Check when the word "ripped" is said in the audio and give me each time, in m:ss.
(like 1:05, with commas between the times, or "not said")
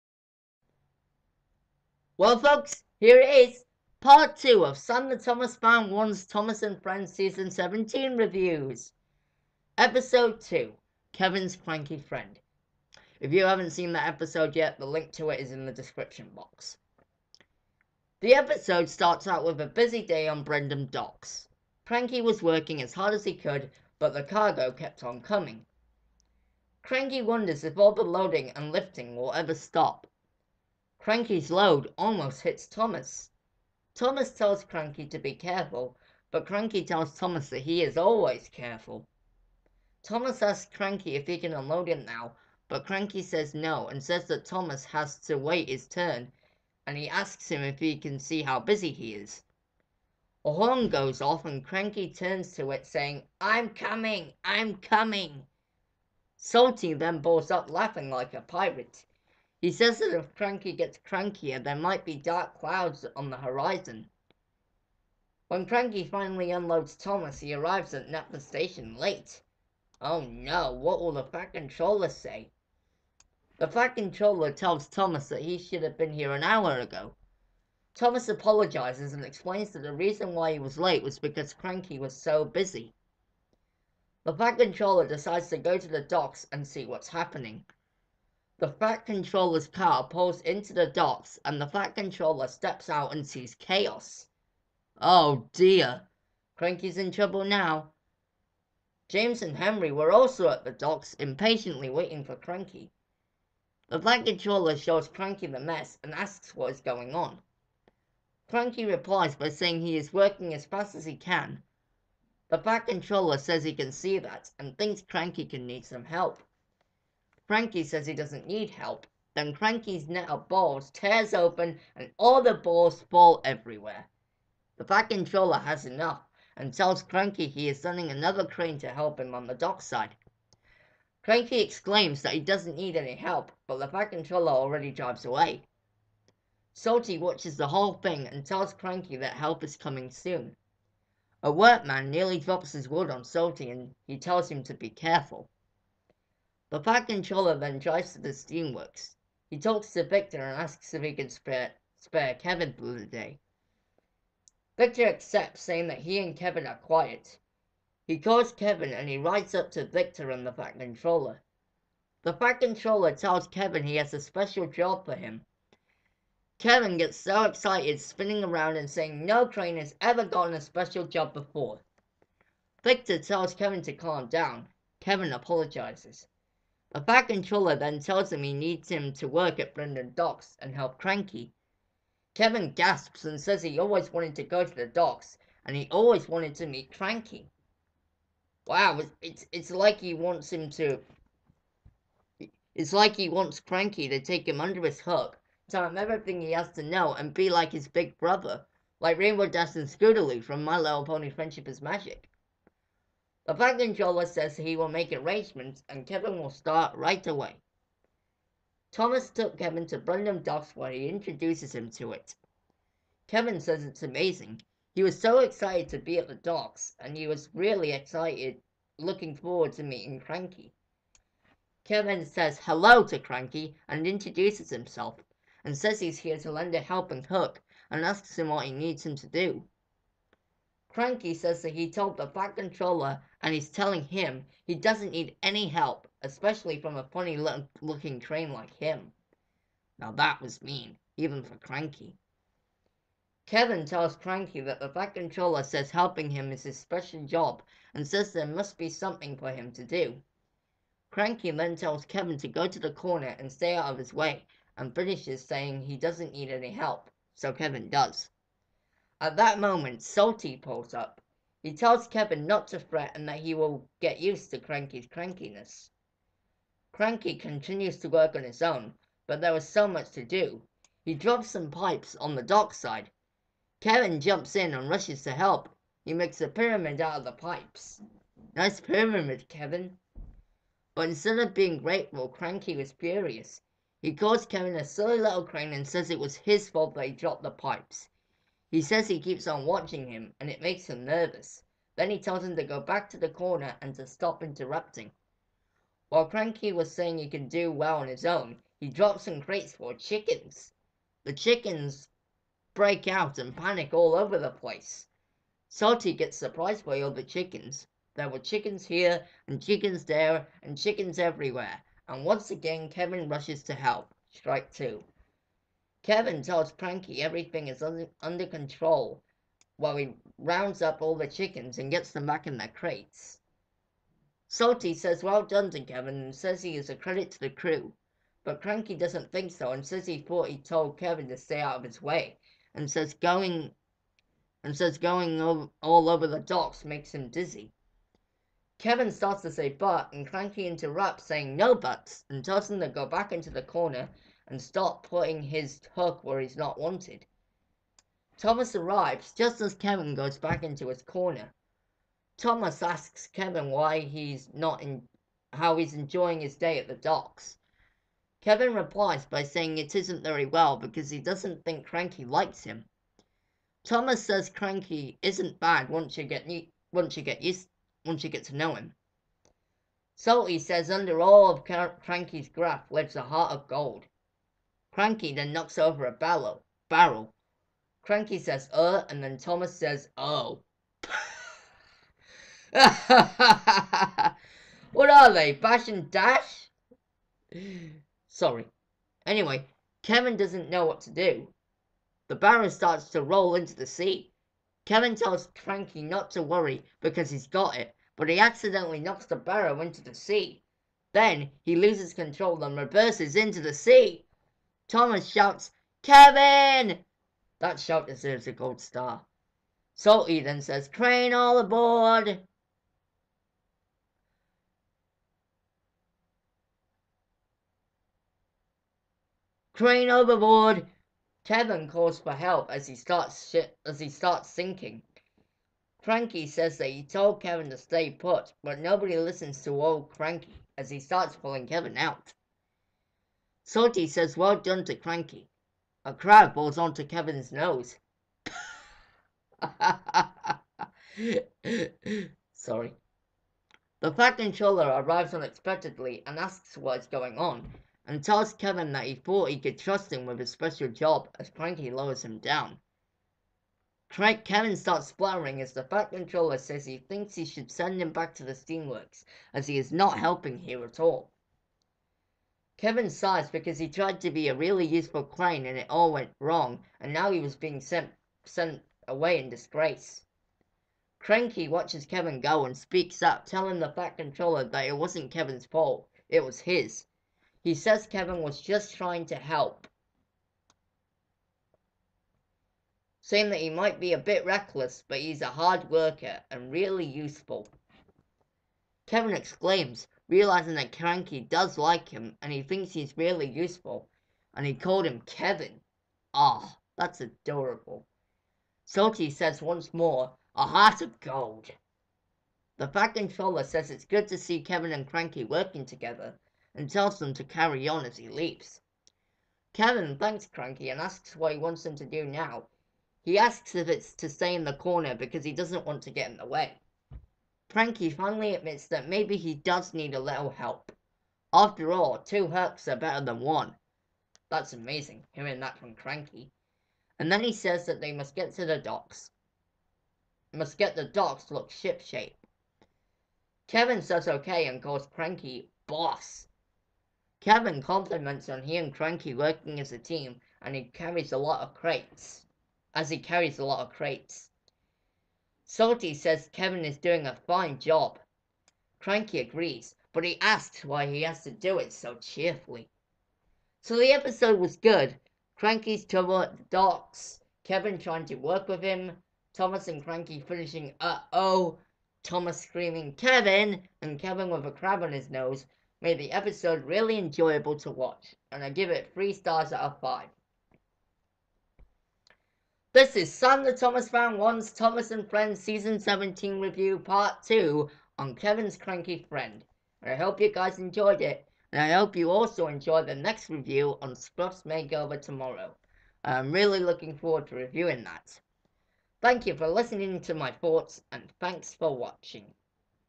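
not said.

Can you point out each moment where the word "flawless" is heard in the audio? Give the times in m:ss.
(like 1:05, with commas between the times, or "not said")
not said.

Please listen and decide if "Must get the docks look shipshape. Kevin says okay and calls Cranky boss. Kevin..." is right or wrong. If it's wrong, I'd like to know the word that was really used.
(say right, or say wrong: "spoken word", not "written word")
right.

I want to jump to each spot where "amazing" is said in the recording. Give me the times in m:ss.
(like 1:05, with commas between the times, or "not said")
3:34, 8:44.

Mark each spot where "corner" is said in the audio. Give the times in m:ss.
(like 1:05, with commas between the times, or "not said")
4:12, 4:53, 5:43, 5:51, 8:34.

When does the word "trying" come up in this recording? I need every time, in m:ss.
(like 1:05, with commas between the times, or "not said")
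7:58, 9:17.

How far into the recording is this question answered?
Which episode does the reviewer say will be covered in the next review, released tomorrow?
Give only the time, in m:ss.
9:44.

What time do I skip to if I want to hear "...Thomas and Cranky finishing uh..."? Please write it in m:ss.
9:19.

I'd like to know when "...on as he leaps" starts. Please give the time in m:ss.
8:27.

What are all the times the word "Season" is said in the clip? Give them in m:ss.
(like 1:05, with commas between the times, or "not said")
0:07, 9:35.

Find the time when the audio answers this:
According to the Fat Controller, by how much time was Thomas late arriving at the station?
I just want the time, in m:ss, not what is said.
1:16.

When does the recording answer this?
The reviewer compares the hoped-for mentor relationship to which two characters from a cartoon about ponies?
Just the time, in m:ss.
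3:19.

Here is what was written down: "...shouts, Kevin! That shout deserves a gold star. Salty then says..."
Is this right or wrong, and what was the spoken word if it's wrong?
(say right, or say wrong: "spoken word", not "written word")
right.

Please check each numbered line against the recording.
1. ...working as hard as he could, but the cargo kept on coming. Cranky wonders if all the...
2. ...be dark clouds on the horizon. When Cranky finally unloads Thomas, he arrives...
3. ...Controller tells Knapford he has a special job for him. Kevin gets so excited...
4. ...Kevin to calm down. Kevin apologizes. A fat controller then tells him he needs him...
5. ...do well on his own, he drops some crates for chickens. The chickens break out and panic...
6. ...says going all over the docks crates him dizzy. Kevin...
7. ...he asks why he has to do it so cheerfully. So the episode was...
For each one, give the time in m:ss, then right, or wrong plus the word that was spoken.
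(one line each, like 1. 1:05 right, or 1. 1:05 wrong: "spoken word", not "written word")
1. 0:22 right
2. 1:02 right
3. 2:42 wrong: "Kevin", not "Knapford"
4. 2:53 right
5. 4:57 right
6. 5:34 wrong: "makes", not "crates"
7. 9:10 right.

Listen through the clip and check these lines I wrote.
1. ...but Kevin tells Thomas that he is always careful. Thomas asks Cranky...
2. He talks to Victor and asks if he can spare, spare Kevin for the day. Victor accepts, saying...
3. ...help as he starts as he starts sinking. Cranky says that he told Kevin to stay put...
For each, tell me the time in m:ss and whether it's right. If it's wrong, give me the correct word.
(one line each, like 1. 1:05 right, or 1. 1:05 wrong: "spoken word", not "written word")
1. 0:36 wrong: "Cranky", not "Kevin"
2. 2:29 right
3. 7:02 right.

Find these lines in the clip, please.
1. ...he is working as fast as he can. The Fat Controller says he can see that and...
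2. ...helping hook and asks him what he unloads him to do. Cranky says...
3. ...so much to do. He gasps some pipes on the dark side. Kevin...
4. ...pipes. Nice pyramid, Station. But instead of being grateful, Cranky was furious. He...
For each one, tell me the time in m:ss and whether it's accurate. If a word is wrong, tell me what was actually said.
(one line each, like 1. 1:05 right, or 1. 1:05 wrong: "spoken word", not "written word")
1. 1:49 right
2. 3:46 wrong: "needs", not "unloads"
3. 4:29 wrong: "drops", not "gasps"
4. 4:37 wrong: "Kevin", not "Station".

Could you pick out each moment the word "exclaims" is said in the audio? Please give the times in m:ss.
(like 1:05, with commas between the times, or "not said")
2:11, 8:09.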